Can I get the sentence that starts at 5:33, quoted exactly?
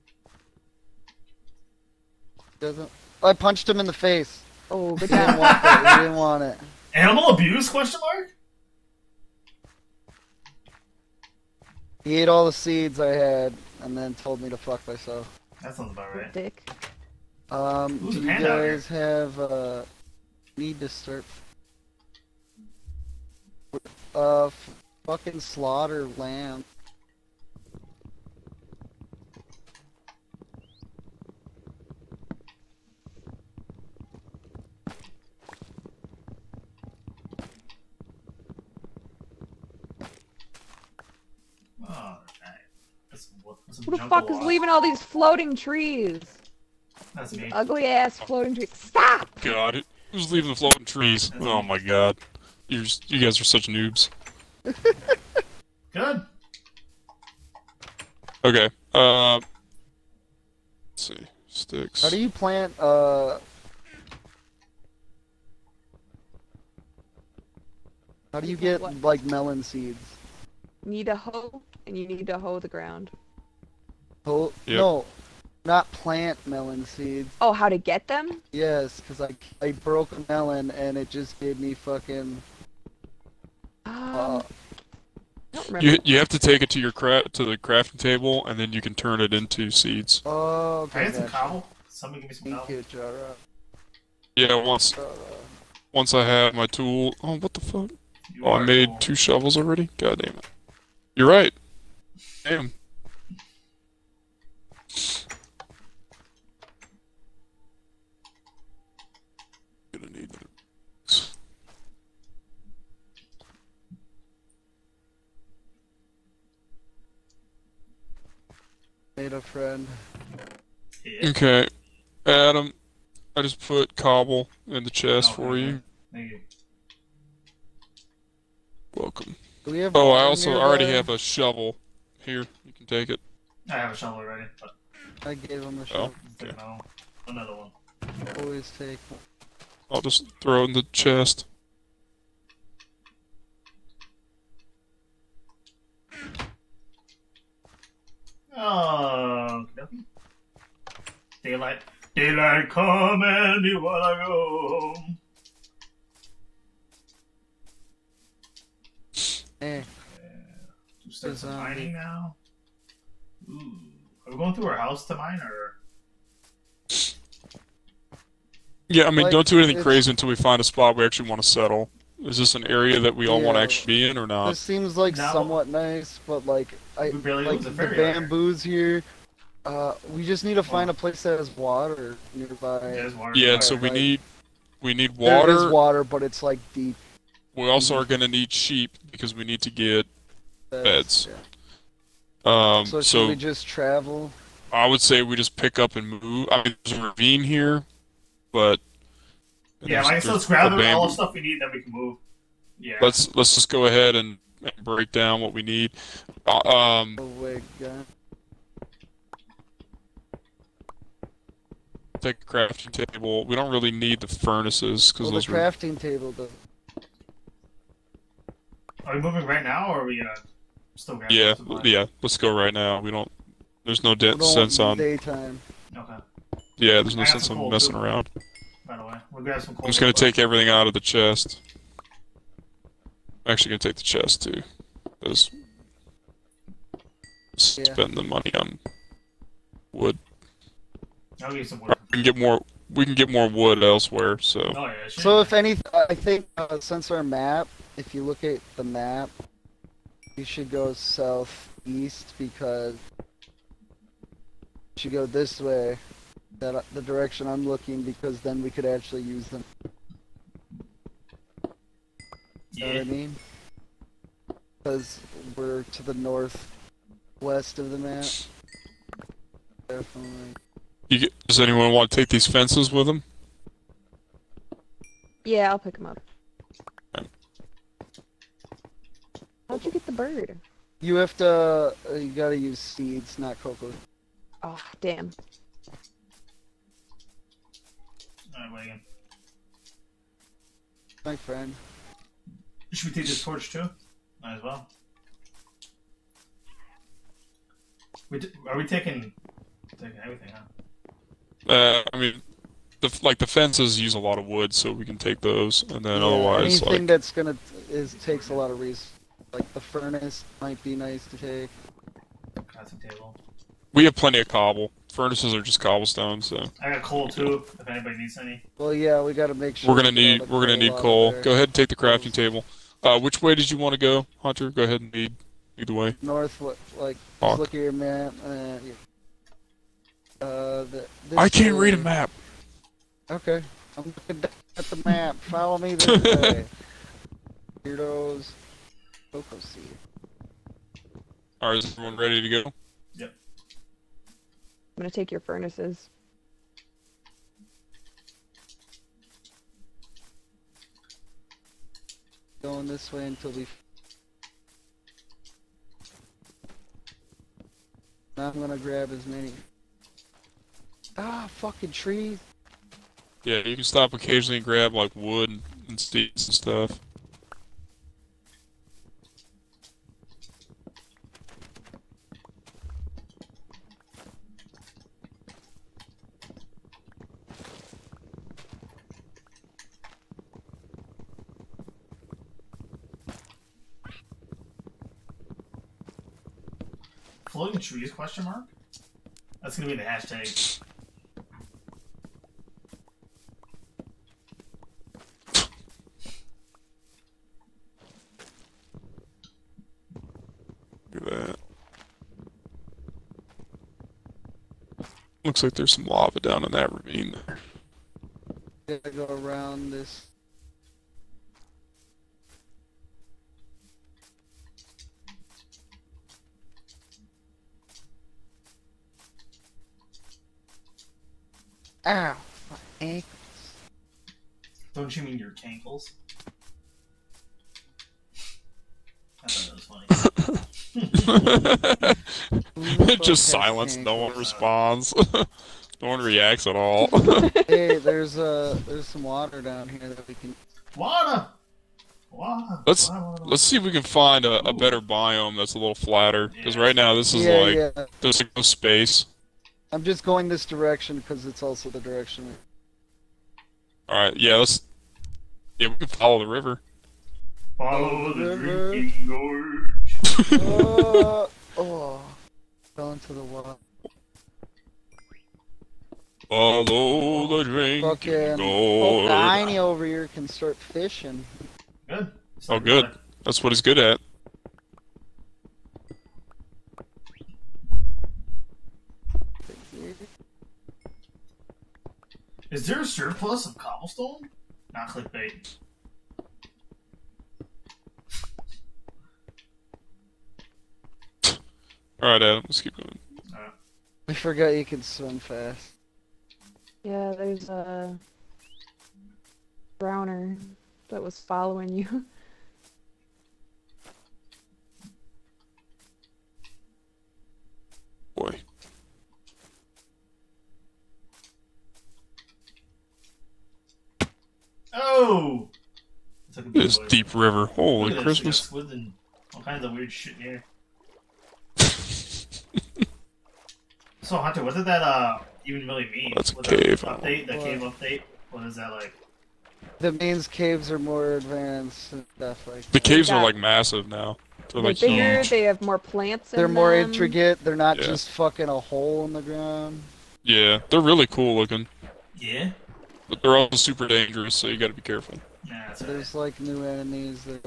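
Okay, I'm looking at the map.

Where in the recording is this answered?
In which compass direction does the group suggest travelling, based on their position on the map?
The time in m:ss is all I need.
4:10.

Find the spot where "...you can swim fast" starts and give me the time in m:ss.
8:14.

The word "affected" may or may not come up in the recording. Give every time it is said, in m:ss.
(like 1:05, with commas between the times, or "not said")
not said.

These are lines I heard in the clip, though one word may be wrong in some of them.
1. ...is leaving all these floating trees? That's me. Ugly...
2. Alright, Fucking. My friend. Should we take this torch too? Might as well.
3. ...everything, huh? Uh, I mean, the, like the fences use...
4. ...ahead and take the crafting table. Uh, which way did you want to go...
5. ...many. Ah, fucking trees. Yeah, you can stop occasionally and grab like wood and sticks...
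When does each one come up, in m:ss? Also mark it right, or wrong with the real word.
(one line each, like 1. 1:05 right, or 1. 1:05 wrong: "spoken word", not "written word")
1. 0:44 right
2. 4:48 wrong: "Wagon", not "Fucking"
3. 5:00 right
4. 5:21 right
5. 5:59 right.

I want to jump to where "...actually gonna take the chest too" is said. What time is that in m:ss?
3:53.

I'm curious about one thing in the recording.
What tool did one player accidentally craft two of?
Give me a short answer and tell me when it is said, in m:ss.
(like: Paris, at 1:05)
Shovels, at 1:38.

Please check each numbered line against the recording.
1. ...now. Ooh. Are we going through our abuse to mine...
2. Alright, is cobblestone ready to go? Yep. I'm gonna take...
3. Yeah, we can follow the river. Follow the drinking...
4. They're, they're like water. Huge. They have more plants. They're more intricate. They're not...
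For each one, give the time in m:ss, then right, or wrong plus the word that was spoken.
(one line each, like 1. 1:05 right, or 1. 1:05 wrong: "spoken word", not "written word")
1. 2:41 wrong: "house", not "abuse"
2. 5:41 wrong: "everyone", not "cobblestone"
3. 7:35 right
4. 8:54 wrong: "bigger", not "water".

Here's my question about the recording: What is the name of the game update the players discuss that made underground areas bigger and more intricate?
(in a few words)
The cave update.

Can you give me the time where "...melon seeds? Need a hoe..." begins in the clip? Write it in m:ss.
1:09.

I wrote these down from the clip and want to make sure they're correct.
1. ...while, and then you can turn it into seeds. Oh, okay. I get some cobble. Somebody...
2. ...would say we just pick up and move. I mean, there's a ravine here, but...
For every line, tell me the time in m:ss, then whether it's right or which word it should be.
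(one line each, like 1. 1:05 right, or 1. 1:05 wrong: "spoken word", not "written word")
1. 1:27 wrong: "table", not "while"
2. 3:14 right.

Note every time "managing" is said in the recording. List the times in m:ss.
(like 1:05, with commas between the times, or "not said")
not said.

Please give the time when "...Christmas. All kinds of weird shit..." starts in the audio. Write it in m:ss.
8:38.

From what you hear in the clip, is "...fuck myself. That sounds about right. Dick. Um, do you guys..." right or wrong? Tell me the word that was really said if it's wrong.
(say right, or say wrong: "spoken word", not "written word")
right.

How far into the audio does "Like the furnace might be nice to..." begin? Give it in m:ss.
5:09.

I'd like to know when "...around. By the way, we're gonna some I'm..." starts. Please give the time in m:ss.
3:47.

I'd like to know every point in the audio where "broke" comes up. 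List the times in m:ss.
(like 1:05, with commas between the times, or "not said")
1:19.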